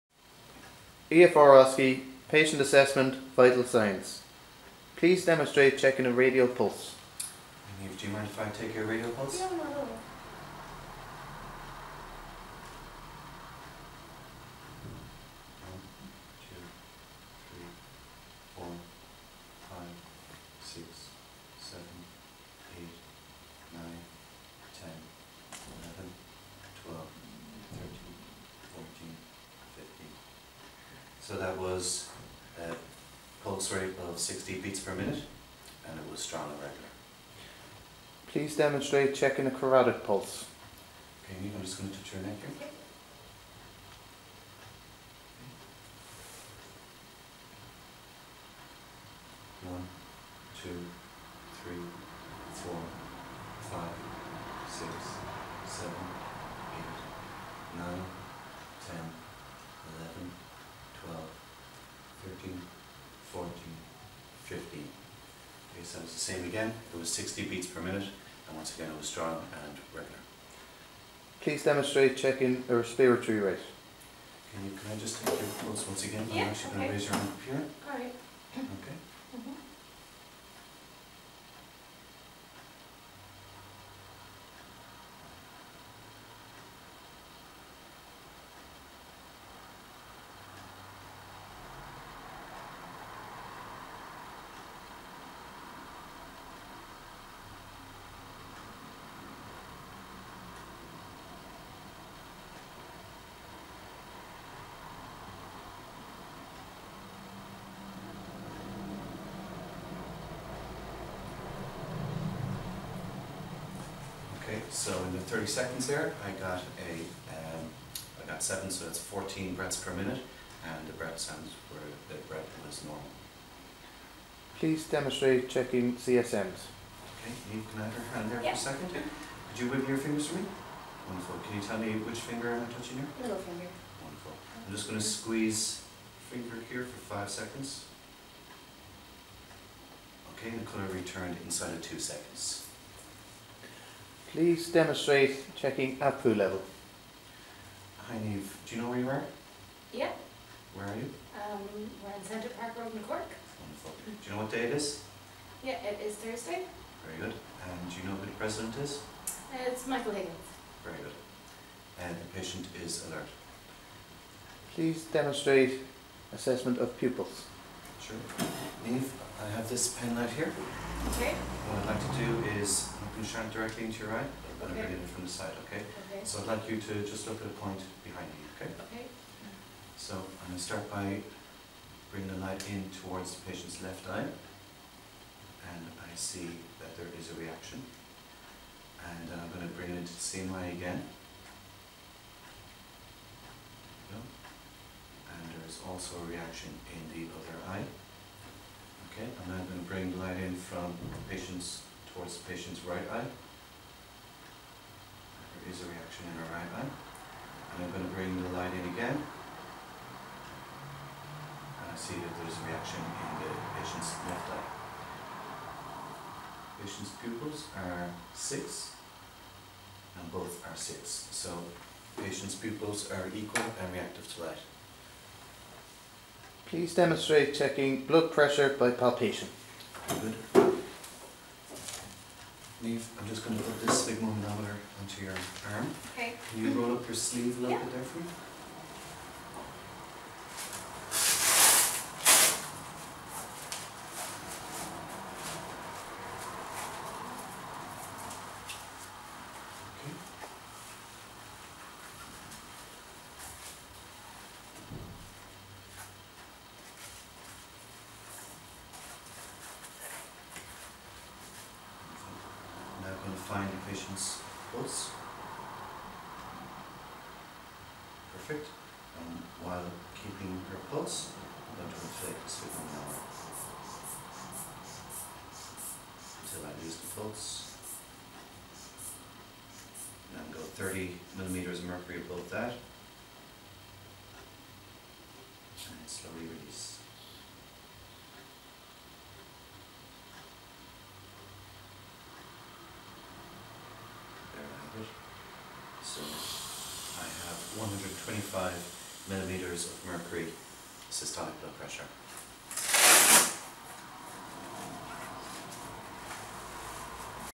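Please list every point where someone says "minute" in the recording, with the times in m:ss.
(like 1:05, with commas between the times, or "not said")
0:34, 1:07, 1:59.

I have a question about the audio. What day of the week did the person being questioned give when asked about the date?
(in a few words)
Thursday.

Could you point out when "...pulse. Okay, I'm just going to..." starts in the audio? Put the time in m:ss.
0:40.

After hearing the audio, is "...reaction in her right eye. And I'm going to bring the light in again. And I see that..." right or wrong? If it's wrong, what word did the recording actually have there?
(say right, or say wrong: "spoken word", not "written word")
right.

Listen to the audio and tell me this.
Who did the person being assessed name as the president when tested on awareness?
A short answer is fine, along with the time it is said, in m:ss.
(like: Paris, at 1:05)
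Michael Higgins, at 2:39.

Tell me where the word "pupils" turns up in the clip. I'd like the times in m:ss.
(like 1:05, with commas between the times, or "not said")
2:46, 3:37, 3:42.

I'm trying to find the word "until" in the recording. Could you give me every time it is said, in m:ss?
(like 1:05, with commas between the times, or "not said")
4:36.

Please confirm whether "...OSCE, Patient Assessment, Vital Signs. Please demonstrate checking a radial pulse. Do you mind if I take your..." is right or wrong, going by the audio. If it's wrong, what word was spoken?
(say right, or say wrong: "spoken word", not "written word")
right.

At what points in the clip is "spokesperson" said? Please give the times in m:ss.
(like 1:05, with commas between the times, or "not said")
not said.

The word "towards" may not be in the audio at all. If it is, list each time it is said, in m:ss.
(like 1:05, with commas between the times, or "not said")
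3:03, 3:22.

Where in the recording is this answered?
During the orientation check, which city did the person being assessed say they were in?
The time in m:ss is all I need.
2:33.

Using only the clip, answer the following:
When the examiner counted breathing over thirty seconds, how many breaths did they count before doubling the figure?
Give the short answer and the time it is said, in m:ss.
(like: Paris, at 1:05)
7, at 1:58.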